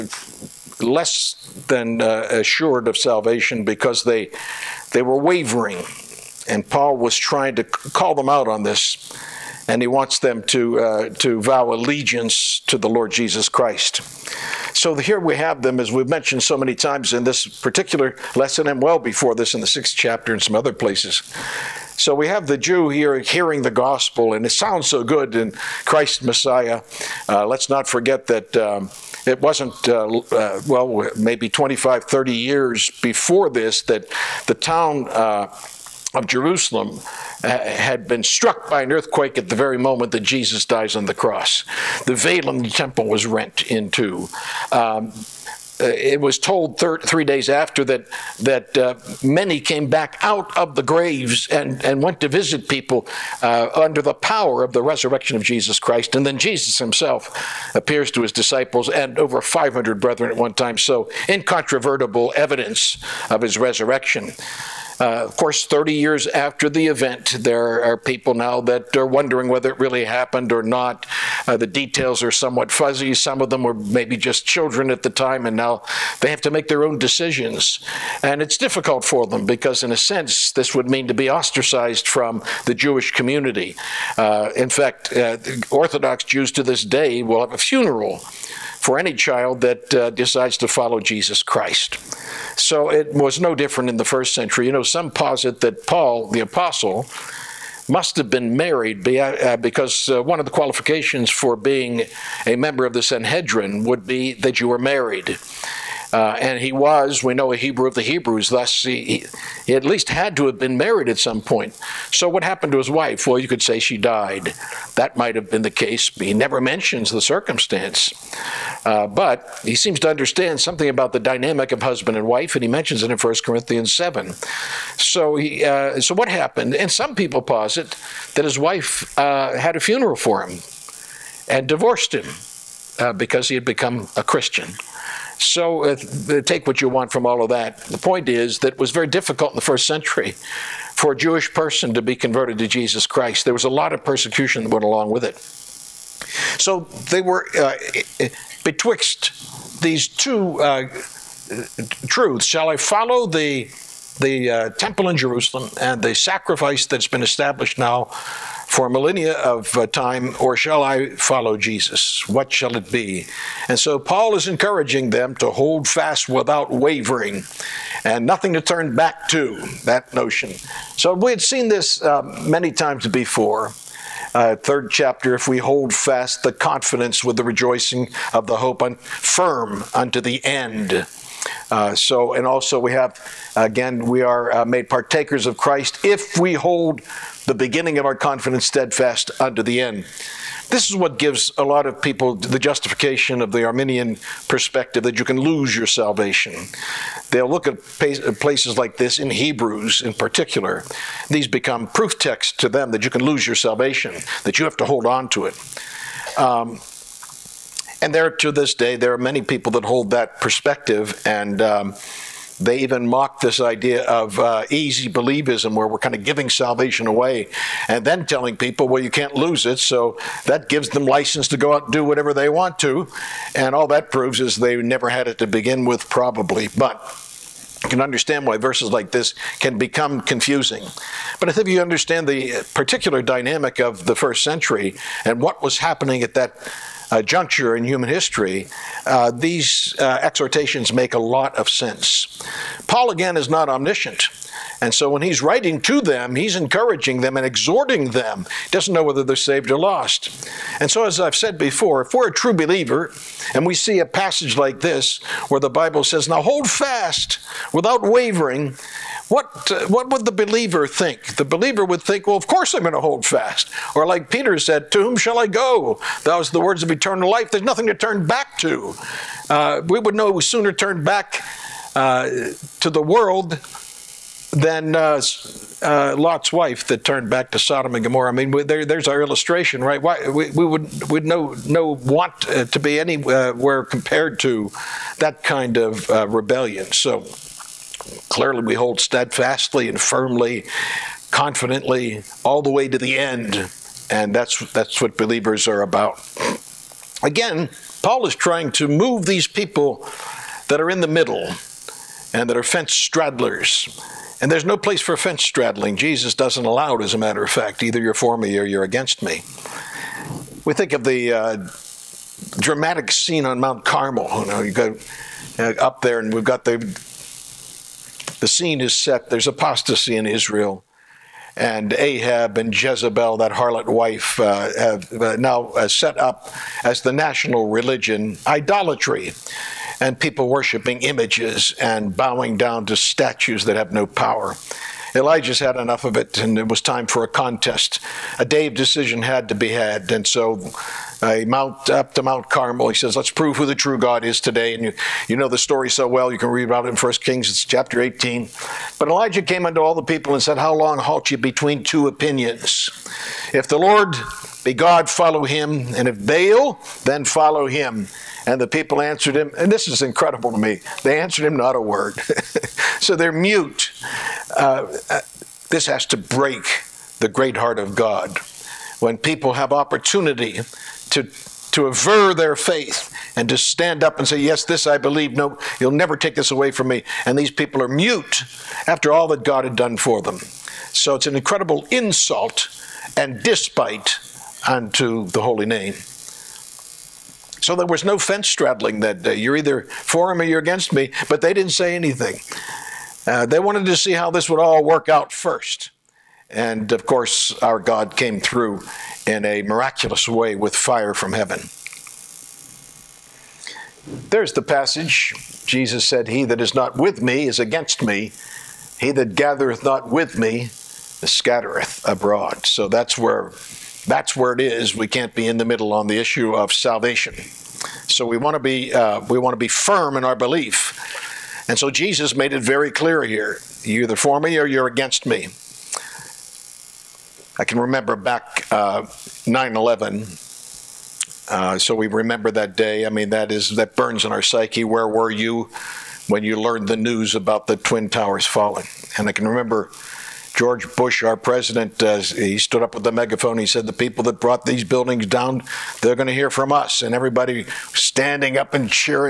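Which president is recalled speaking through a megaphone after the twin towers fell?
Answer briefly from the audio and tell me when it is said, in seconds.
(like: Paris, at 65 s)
George Bush, at 440 s.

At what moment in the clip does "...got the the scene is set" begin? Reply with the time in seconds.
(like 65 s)
316 s.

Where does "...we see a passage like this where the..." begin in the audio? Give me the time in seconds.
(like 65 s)
253 s.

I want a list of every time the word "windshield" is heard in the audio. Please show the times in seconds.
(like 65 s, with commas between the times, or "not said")
not said.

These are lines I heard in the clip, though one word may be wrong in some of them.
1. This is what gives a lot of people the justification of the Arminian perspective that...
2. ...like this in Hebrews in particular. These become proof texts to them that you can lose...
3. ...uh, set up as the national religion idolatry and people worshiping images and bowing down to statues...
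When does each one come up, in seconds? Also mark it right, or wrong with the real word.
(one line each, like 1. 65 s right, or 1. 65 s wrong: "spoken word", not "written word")
1. 190 s right
2. 198 s right
3. 325 s right.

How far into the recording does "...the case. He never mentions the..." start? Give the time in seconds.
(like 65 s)
115 s.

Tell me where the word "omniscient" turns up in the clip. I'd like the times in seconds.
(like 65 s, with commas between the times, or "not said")
243 s.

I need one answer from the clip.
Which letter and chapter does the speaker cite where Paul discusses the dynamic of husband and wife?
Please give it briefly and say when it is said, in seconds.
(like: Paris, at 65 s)
1 Corinthians 7, at 123 s.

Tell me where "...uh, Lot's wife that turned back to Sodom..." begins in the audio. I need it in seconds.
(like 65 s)
275 s.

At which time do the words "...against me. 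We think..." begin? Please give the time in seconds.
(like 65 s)
308 s.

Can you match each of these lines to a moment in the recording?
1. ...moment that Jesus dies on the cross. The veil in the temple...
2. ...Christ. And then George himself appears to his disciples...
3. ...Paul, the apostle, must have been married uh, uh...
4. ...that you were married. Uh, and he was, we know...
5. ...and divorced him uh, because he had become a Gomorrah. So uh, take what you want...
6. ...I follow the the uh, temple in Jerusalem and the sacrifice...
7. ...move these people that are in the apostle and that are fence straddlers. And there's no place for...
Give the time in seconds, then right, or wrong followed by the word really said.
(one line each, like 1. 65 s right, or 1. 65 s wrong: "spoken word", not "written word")
1. 39 s right
2. 55 s wrong: "Jesus", not "George"
3. 95 s right
4. 104 s right
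5. 131 s wrong: "Christian", not "Gomorrah"
6. 152 s right
7. 298 s wrong: "middle", not "apostle".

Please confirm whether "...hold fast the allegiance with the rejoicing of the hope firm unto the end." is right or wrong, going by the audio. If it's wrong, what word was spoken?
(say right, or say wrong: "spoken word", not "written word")
wrong: "confidence", not "allegiance".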